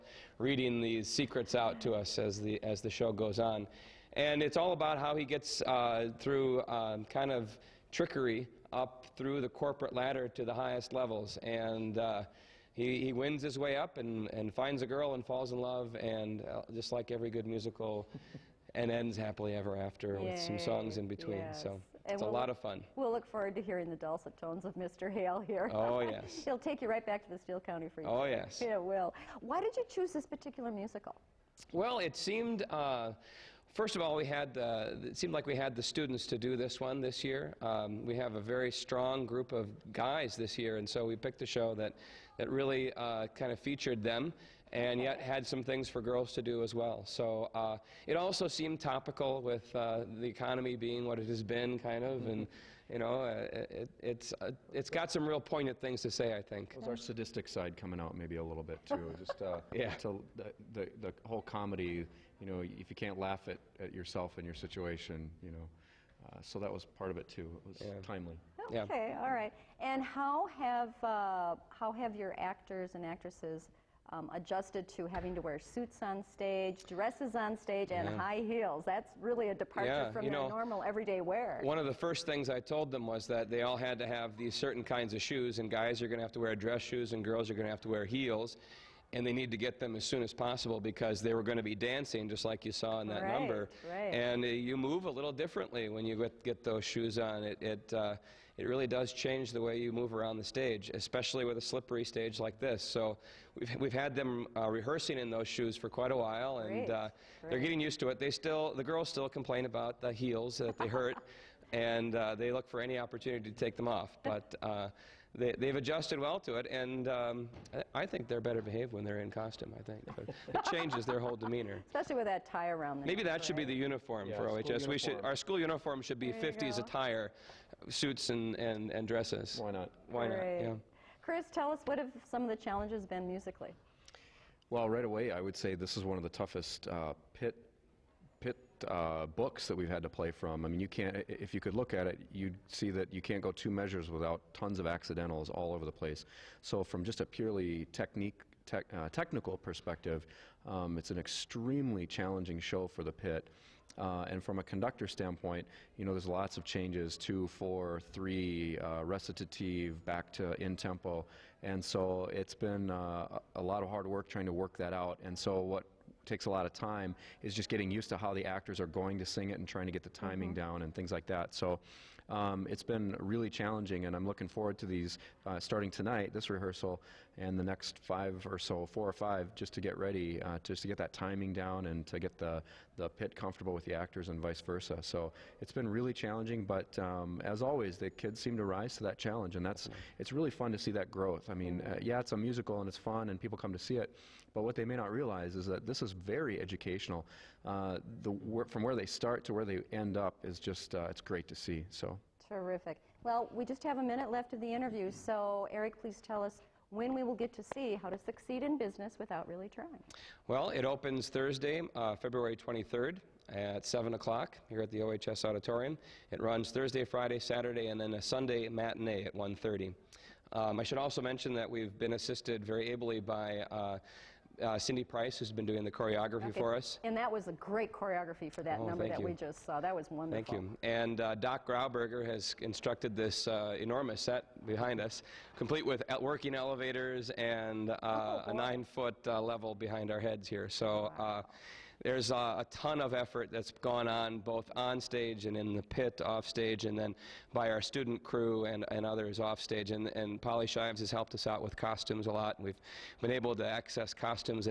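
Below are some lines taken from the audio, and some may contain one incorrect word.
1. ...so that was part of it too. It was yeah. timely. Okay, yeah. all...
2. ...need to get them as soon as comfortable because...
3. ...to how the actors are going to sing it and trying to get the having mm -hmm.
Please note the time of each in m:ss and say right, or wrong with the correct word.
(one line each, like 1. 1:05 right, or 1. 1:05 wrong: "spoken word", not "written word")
1. 1:06 right
2. 1:29 wrong: "possible", not "comfortable"
3. 2:48 wrong: "timing", not "having".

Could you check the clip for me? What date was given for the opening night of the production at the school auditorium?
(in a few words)
February 23rd.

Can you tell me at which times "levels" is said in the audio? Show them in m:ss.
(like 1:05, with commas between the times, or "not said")
0:10, 3:59.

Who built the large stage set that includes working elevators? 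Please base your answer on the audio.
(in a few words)
Doc Grauberger.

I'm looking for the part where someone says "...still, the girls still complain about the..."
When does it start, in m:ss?
1:48.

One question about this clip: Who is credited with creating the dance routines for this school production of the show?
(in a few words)
Cindy Price.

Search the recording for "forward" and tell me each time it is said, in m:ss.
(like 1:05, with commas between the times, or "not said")
0:23, 2:54.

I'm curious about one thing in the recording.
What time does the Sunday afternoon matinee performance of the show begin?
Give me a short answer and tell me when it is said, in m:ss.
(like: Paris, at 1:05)
1:30, at 3:39.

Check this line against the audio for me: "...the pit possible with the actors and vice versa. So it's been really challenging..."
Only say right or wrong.
wrong.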